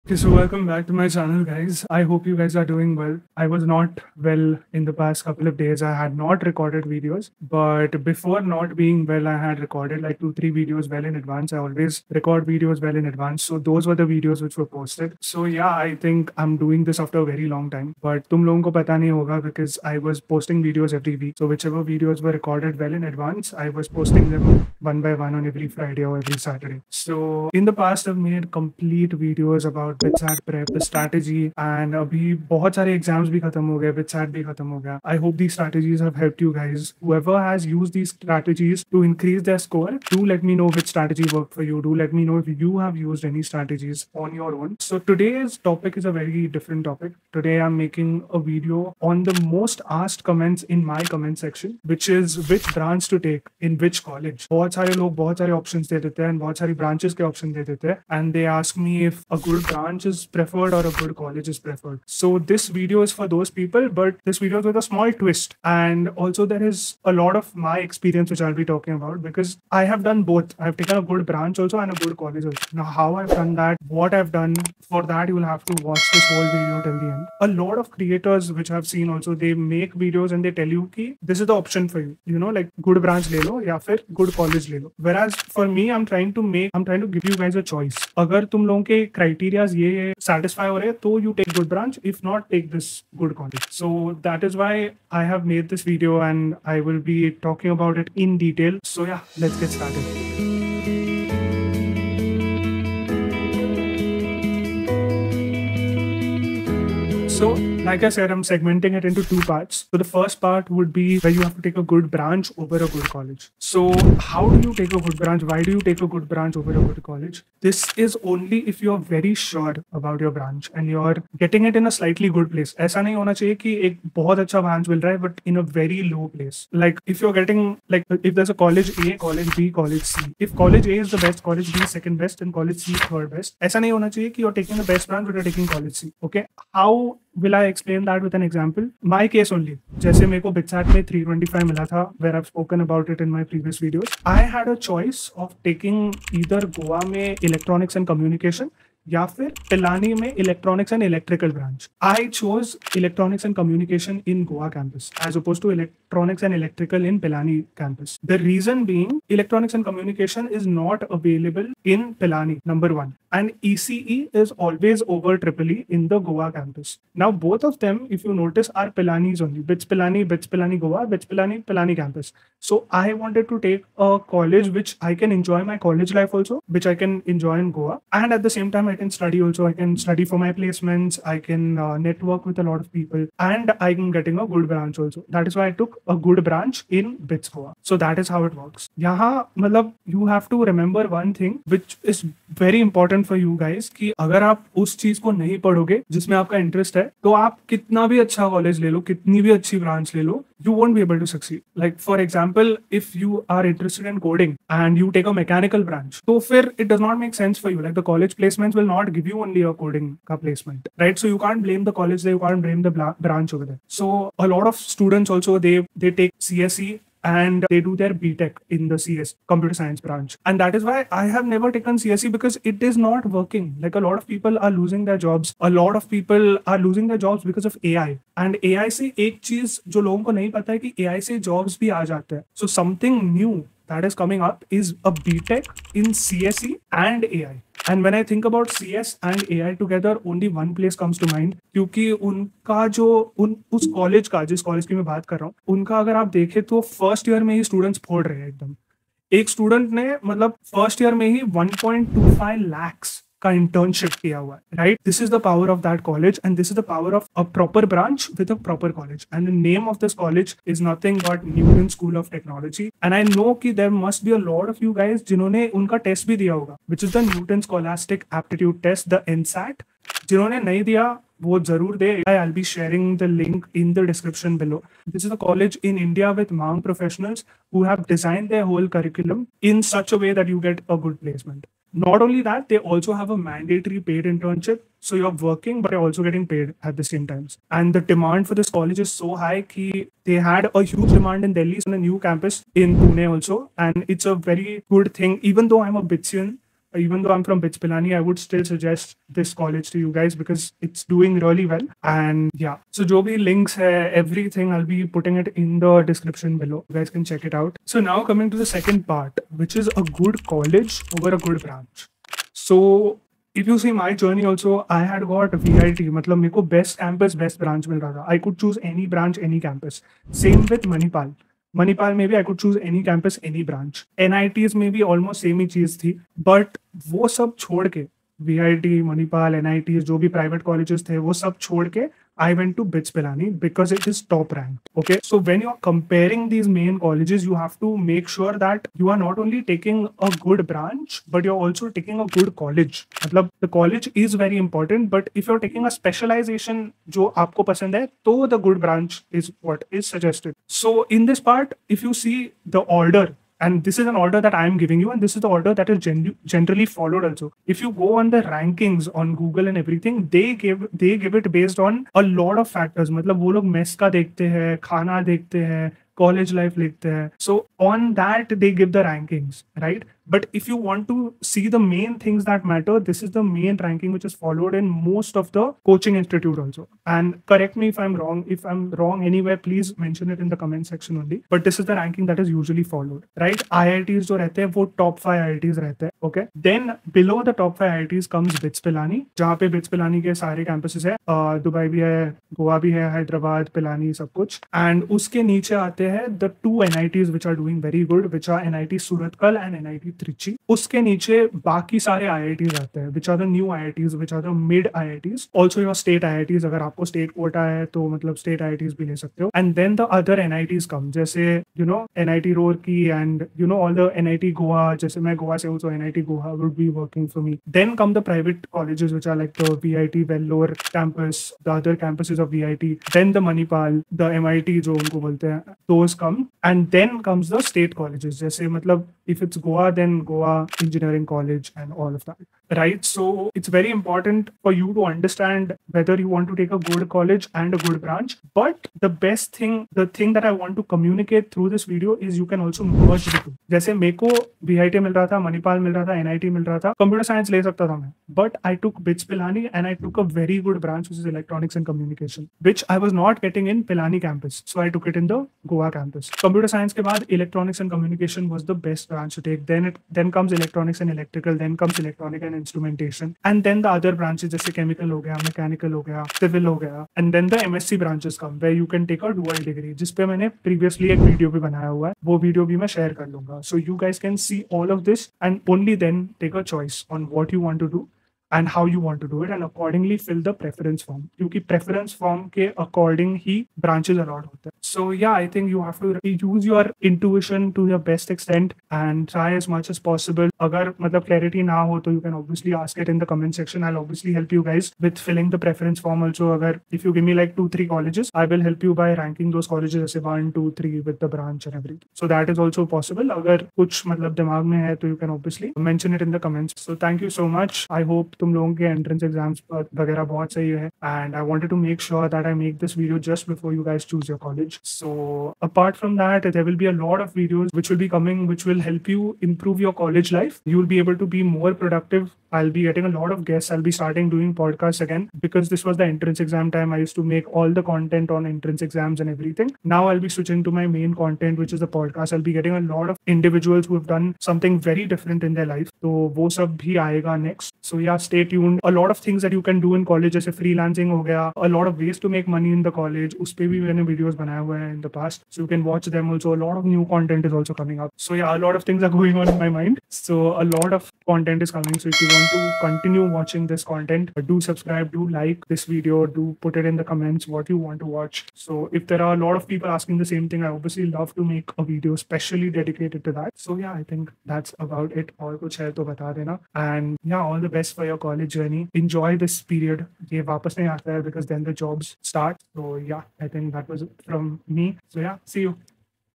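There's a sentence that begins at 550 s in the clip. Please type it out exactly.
So a lot of content is coming.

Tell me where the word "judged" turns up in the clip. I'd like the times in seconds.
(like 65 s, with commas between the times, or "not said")
not said.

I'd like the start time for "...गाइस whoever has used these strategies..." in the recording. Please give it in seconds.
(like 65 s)
36 s.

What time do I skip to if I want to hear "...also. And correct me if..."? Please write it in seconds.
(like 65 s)
376 s.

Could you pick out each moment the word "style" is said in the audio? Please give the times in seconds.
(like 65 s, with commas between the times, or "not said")
not said.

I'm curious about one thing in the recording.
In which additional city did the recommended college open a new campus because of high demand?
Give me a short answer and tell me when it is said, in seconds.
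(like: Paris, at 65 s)
Pune, at 292 s.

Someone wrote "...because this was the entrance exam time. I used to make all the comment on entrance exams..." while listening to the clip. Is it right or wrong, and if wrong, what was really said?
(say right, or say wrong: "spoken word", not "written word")
wrong: "content", not "comment".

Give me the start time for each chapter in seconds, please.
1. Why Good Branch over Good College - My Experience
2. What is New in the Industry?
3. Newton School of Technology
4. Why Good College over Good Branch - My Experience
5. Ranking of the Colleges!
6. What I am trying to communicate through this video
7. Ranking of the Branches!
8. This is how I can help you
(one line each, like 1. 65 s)
1. 105 s
2. 190 s
3. 230 s
4. 305 s
5. 380 s
6. 432 s
7. 455 s
8. 495 s.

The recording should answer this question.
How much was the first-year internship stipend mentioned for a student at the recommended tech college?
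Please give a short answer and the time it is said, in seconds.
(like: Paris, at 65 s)
1.25 lakhs, at 251 s.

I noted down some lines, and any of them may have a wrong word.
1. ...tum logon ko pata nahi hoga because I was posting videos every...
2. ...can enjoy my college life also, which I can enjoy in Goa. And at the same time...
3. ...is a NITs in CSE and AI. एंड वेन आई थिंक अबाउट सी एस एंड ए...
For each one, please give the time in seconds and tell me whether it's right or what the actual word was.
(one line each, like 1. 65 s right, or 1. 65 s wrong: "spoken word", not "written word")
1. 18 s right
2. 175 s right
3. 234 s wrong: "BTech", not "NITs".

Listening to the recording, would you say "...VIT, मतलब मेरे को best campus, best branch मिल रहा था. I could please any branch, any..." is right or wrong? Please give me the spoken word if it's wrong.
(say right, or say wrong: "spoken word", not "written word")
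wrong: "choose", not "please".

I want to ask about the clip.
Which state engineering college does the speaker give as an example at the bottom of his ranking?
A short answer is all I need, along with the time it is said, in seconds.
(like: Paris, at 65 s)
Goa Engineering College, at 430 s.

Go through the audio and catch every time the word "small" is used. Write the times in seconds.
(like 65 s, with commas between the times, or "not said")
64 s.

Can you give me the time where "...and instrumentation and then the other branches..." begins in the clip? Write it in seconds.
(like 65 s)
462 s.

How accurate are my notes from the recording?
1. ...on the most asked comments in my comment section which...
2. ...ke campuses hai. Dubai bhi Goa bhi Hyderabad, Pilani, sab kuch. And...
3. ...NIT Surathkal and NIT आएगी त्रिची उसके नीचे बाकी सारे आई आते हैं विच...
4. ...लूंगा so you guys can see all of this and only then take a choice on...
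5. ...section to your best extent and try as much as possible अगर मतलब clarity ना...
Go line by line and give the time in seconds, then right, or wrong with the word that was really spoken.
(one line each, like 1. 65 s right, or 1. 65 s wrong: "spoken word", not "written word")
1. 49 s right
2. 390 s right
3. 398 s right
4. 473 s right
5. 487 s wrong: "intuition", not "section".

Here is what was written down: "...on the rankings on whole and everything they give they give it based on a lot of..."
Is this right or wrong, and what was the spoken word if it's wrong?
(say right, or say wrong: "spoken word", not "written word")
wrong: "google", not "whole".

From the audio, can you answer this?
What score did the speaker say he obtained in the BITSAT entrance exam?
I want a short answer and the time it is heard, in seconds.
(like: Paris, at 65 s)
325, at 141 s.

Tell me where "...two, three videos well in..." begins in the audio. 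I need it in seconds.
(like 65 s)
10 s.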